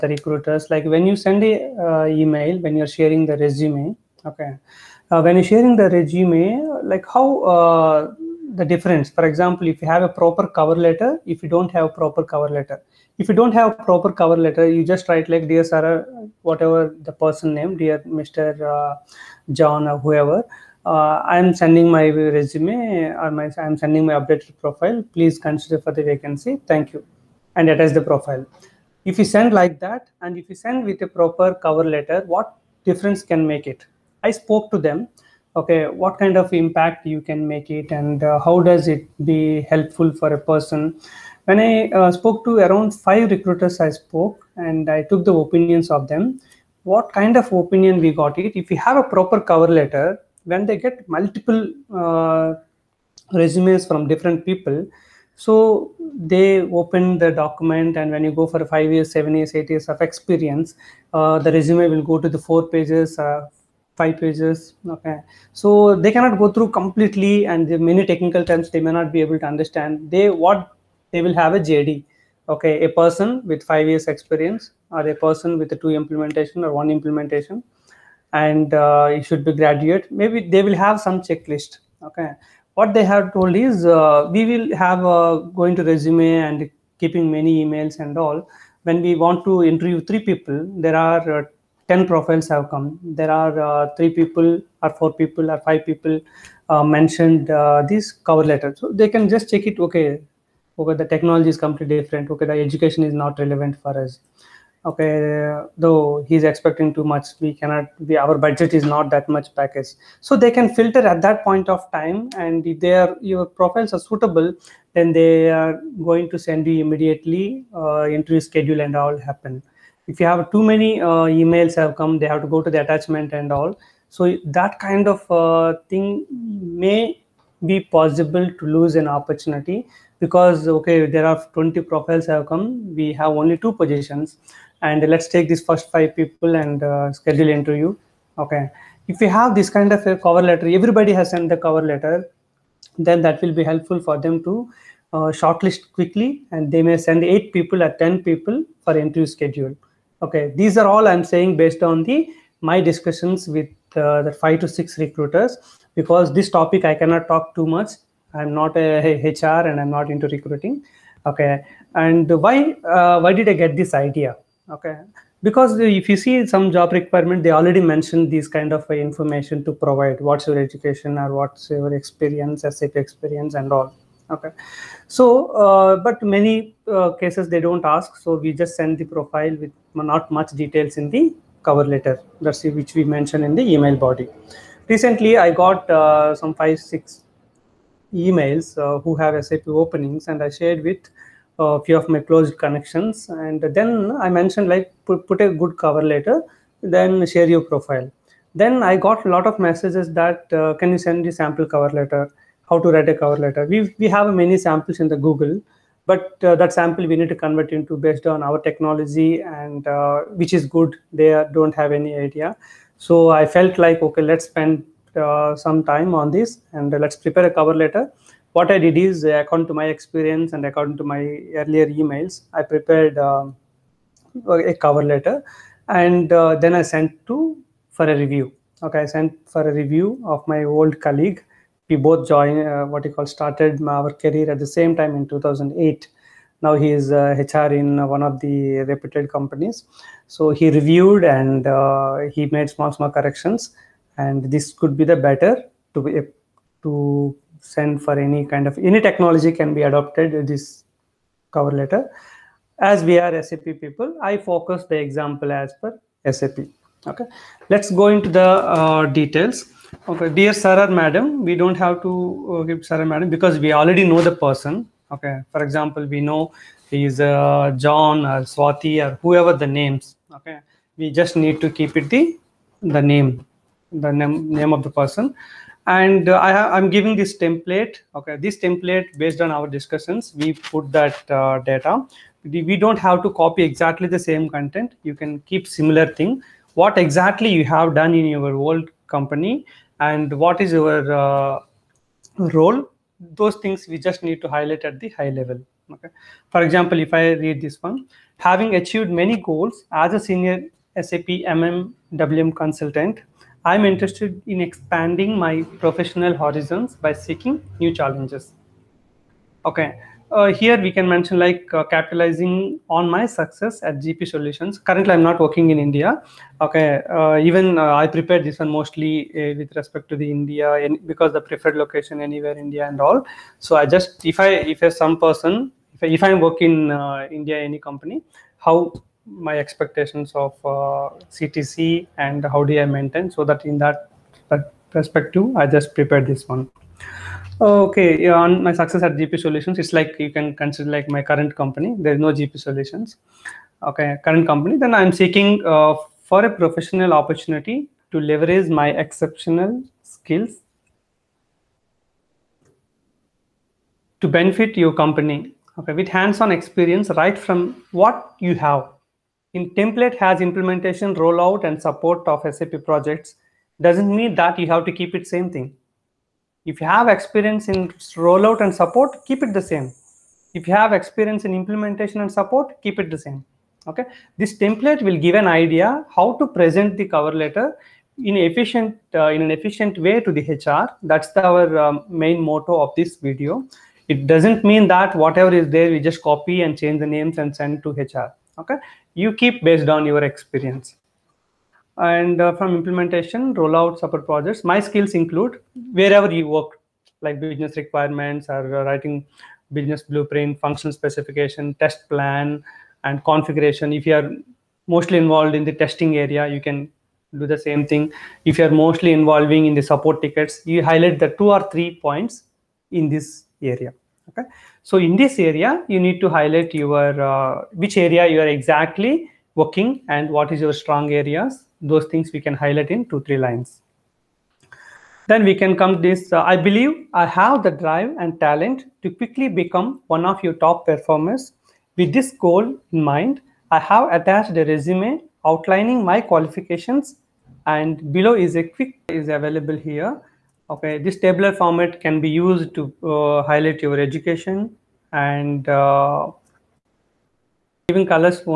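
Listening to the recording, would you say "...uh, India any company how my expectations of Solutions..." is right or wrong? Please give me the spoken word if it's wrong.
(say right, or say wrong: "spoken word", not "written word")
wrong: "CTC", not "Solutions".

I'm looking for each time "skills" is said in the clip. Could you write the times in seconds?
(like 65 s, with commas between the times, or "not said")
350 s, 394 s.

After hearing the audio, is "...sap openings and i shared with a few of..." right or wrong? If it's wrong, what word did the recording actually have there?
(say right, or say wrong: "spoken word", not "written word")
right.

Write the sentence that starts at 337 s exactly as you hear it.
Okay, on my success at GP Solutions, it's like you can consider like my current company.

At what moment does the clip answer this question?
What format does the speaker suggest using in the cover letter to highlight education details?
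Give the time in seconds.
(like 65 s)
441 s.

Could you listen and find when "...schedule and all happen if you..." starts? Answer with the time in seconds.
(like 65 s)
118 s.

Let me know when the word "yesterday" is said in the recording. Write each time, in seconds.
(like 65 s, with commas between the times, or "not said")
not said.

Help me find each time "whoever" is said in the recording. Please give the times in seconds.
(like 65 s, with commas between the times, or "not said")
19 s, 269 s.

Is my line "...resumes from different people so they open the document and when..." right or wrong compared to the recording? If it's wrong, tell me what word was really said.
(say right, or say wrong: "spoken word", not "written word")
right.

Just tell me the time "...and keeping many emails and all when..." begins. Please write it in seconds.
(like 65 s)
86 s.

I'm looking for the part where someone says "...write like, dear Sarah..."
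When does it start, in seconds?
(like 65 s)
15 s.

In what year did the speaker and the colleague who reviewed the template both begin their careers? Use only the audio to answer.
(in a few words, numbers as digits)
2008.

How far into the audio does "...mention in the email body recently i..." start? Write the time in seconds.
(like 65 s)
183 s.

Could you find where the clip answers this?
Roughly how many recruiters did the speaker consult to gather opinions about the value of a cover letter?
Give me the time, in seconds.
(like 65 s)
42 s.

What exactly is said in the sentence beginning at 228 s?
Okay, I sent for a review of my old colleague.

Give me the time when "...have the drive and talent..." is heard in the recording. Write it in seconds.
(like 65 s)
427 s.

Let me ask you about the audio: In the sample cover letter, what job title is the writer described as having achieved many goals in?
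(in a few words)
Senior SAP MMWM consultant.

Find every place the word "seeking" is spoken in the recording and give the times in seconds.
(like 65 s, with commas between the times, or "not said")
307 s, 345 s.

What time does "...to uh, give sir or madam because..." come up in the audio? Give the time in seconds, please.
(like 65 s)
262 s.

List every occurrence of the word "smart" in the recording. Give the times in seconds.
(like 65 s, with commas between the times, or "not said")
not said.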